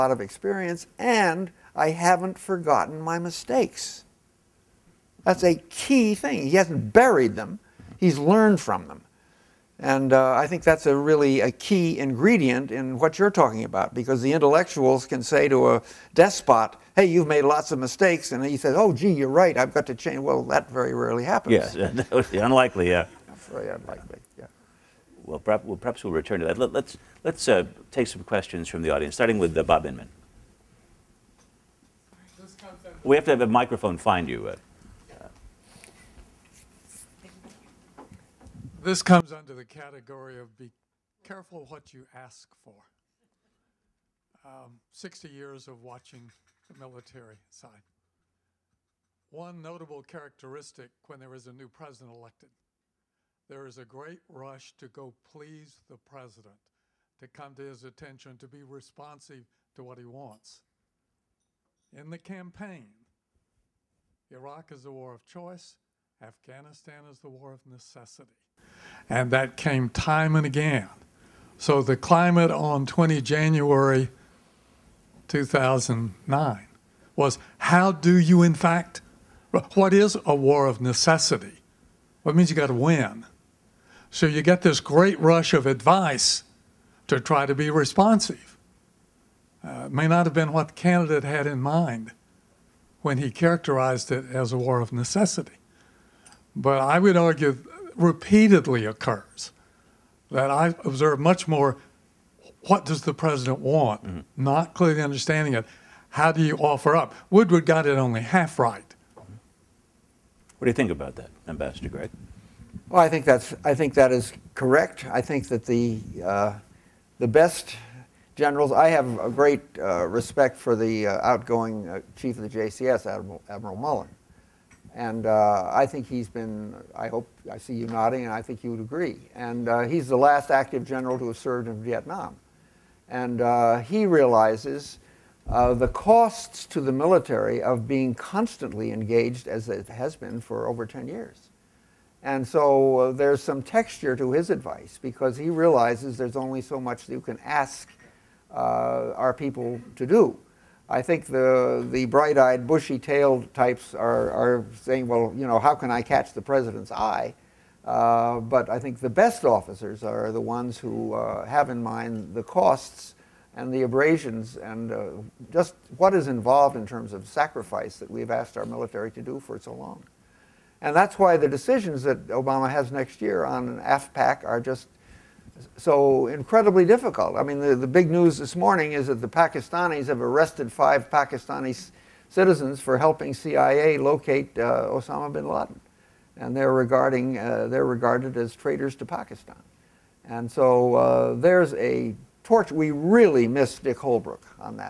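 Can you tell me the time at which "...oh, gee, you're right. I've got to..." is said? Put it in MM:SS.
00:18.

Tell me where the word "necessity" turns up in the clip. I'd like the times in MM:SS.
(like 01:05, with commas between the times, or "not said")
01:07, 01:20, 01:34.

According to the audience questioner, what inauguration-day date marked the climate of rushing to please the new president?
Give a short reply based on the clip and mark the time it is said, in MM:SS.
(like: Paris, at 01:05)
20 January 2009, at 01:12.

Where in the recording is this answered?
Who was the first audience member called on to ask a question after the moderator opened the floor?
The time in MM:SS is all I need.
00:29.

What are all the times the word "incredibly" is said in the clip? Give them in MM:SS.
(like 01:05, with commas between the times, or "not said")
02:56.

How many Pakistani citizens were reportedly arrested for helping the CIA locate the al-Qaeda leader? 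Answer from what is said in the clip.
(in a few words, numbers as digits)
5.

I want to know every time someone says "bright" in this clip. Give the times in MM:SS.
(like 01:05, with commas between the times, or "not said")
02:32.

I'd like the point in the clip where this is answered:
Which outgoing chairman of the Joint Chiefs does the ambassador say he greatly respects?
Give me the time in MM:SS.
02:03.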